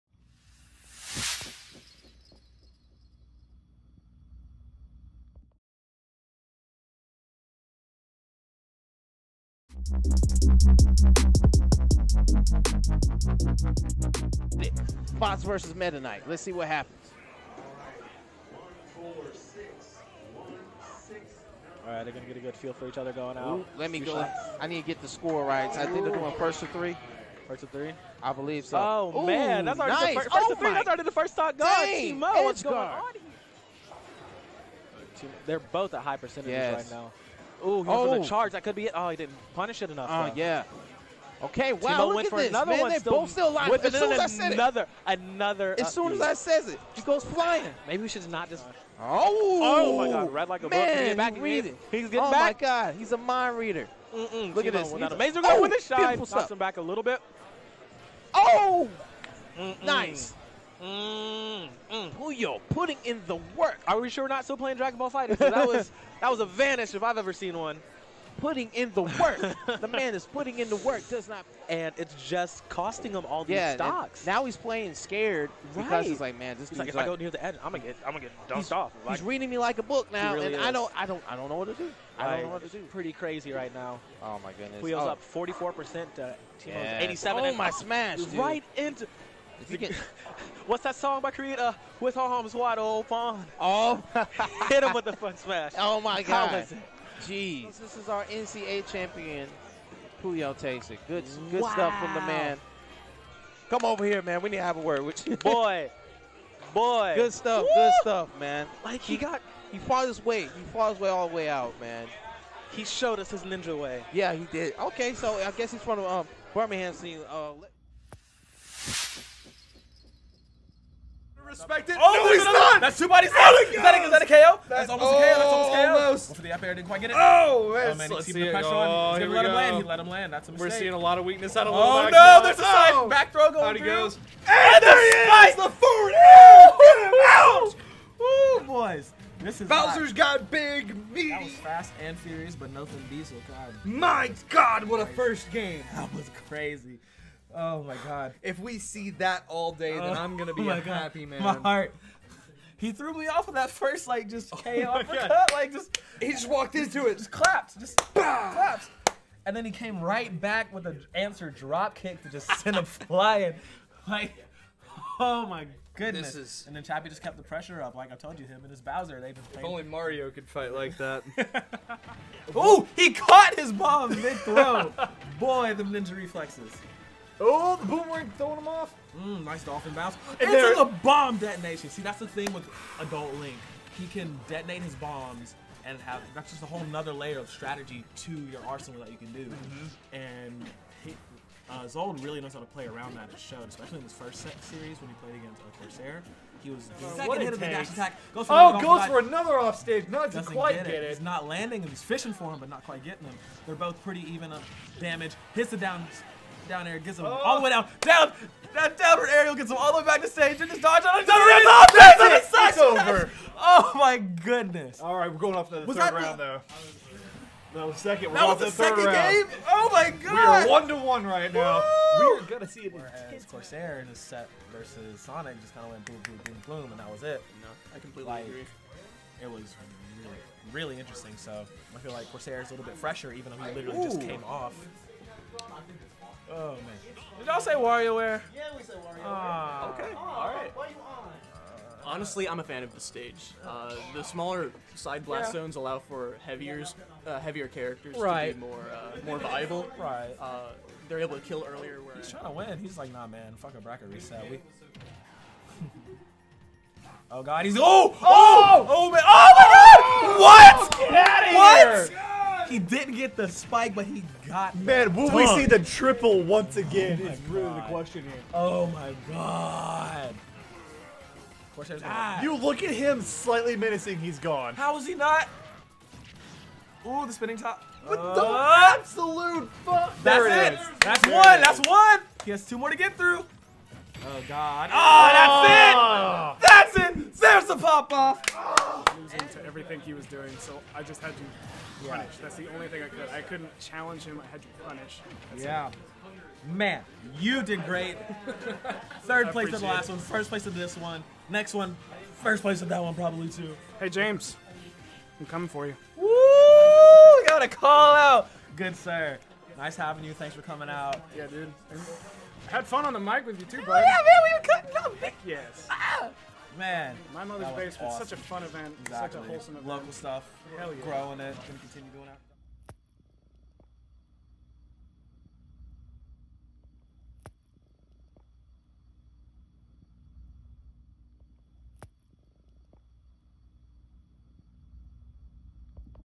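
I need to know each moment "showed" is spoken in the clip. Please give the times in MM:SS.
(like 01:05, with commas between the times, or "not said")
01:52, 03:13.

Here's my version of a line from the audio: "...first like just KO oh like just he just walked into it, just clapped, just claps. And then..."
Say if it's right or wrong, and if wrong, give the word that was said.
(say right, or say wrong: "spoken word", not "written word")
right.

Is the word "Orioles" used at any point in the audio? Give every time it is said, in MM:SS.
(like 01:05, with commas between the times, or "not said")
not said.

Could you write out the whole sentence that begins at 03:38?
We're that was the, the second round.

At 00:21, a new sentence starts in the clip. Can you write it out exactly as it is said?
All right, they're going to get a good feel for each other going out.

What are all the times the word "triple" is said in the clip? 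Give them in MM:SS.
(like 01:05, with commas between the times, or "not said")
04:25.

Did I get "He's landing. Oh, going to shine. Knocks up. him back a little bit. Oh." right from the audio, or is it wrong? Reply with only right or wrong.
wrong.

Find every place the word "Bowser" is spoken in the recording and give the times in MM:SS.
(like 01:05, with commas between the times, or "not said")
02:19, 02:48.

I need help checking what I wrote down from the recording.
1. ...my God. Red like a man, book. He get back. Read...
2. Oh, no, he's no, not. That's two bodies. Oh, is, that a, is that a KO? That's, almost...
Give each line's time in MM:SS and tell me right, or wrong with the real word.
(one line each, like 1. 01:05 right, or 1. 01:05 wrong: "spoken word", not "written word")
1. 00:49 right
2. 02:02 right.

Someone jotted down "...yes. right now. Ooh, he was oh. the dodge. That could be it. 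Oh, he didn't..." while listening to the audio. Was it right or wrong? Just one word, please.
wrong.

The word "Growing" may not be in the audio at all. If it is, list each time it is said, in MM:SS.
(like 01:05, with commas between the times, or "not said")
05:21.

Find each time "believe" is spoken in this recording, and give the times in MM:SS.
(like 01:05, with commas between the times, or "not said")
00:28.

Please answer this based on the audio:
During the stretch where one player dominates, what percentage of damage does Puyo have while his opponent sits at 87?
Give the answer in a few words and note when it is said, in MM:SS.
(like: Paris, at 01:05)
44%, at 01:25.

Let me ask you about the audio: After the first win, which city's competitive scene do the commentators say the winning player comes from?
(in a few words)
Birmingham.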